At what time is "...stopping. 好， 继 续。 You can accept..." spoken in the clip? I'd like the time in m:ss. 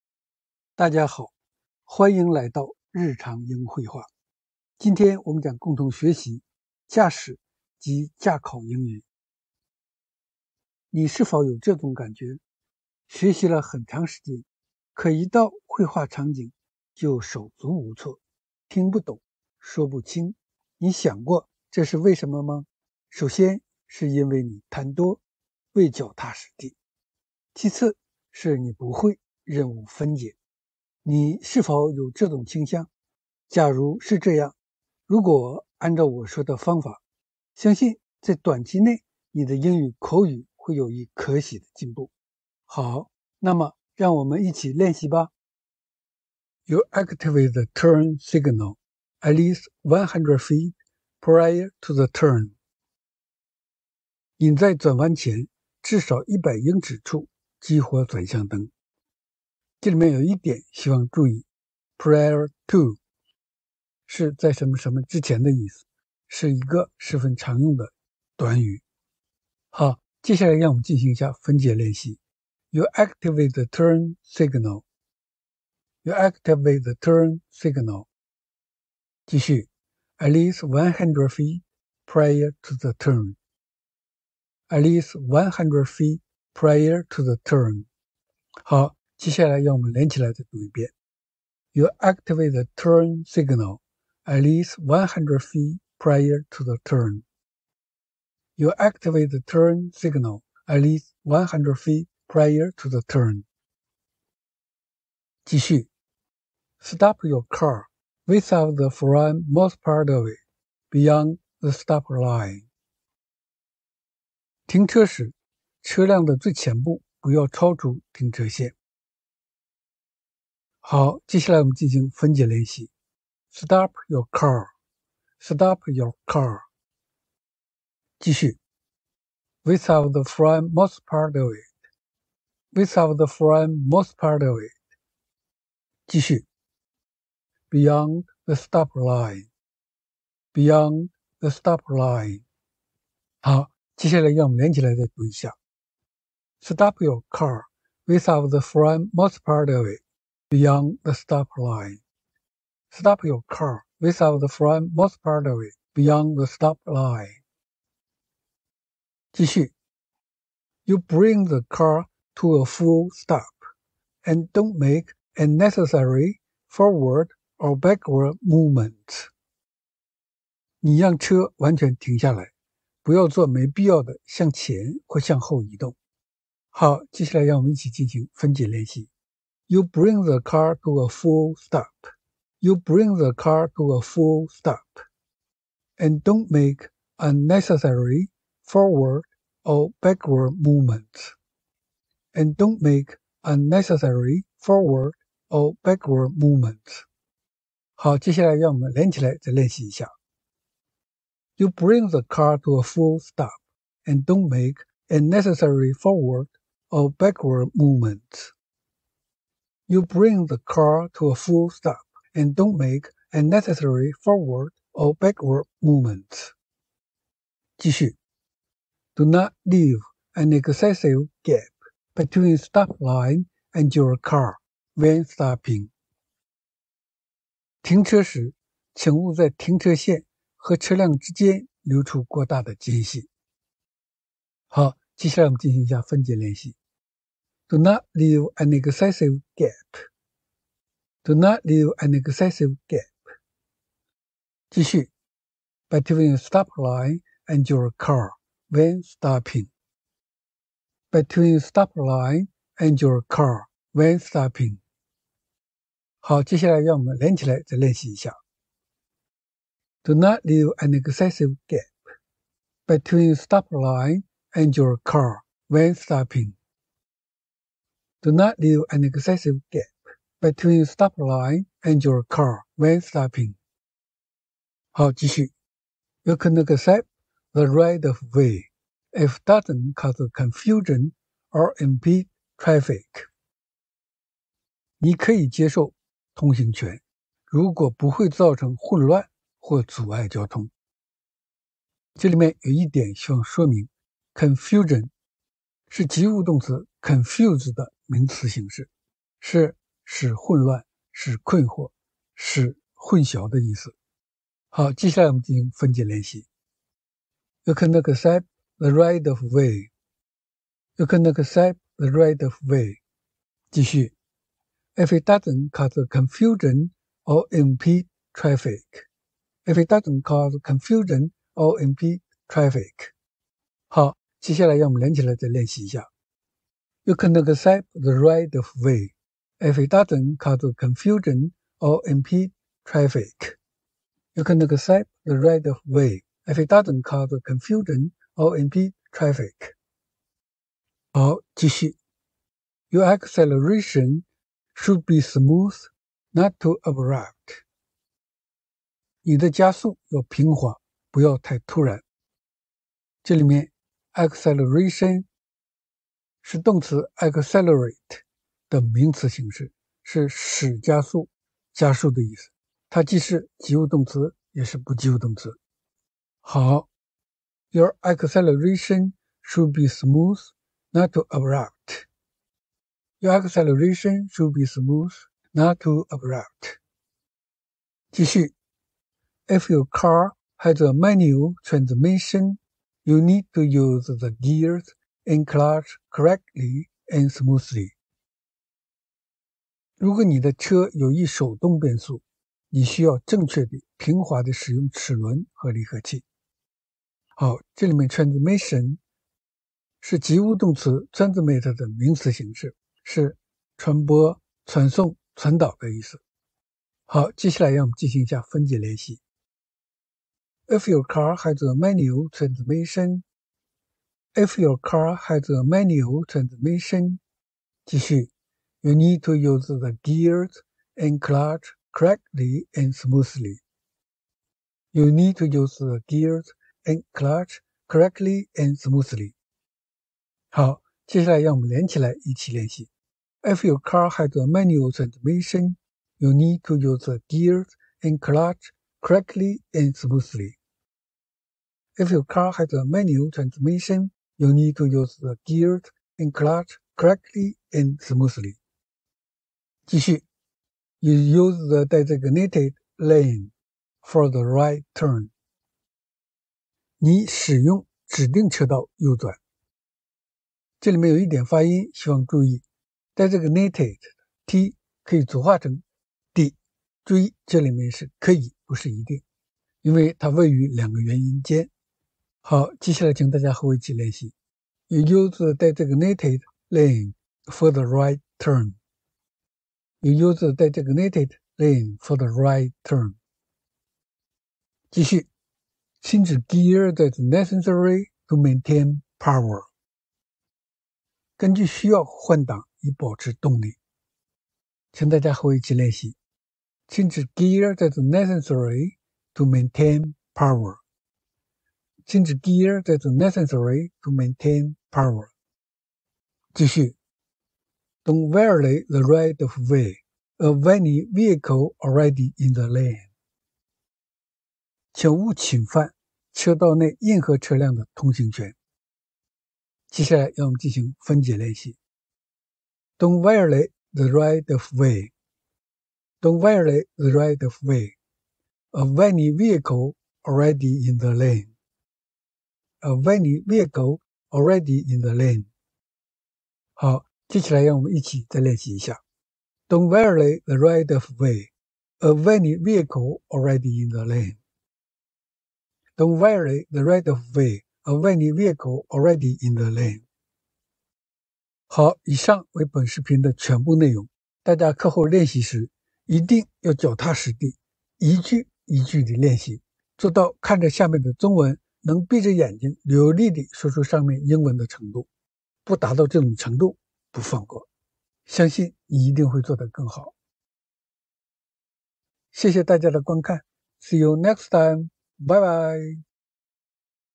4:33.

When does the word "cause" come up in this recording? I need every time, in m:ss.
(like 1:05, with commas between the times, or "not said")
4:39, 5:15, 5:20, 5:30, 5:37.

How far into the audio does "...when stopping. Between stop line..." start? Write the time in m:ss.
4:08.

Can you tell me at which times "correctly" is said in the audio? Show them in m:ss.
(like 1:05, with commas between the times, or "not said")
6:26, 7:01, 7:07, 7:19, 7:26.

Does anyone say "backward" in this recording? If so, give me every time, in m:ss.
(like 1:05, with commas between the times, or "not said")
2:47, 3:10, 3:15, 3:27, 3:35.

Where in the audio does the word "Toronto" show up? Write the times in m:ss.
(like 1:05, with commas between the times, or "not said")
not said.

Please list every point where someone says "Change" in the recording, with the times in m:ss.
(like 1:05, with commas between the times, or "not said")
8:04, 8:16.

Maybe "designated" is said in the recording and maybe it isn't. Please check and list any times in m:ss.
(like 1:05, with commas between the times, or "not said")
7:31, 7:43, 7:55, 8:00.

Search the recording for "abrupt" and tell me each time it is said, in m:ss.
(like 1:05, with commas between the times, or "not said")
5:46, 6:11, 6:16.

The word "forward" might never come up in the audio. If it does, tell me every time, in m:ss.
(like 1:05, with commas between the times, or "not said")
2:46, 3:08, 3:14, 3:25, 3:34.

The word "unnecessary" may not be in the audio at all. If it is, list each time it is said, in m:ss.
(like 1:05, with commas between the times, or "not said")
2:45, 3:07, 3:13, 3:25, 3:33.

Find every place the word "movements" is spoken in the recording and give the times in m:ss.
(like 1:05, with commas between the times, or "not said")
2:48, 3:10, 3:16, 3:27, 3:35.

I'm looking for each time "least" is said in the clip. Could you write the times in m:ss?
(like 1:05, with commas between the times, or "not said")
0:49, 1:20, 1:24, 1:34, 1:40.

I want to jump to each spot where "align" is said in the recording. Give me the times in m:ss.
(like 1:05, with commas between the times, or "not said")
not said.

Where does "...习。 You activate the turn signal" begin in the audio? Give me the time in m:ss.
1:11.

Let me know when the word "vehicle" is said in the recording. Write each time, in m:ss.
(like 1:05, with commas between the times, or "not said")
8:31, 8:49, 8:53, 9:02, 9:08.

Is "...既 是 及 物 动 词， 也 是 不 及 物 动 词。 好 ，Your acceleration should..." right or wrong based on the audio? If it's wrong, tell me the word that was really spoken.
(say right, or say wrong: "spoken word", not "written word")
right.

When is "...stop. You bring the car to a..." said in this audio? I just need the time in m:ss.
3:01.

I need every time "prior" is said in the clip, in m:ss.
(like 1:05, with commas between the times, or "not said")
0:51, 1:01, 1:22, 1:26, 1:35, 1:42.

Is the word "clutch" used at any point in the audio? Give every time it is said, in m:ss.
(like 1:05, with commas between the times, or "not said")
6:25, 7:01, 7:07, 7:18, 7:26.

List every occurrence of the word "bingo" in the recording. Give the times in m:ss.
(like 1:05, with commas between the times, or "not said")
not said.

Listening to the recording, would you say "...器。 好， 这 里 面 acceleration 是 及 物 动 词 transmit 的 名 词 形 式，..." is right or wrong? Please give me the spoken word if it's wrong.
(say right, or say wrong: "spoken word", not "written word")
wrong: "transmission", not "acceleration".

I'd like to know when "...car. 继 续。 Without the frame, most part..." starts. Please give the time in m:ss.
2:06.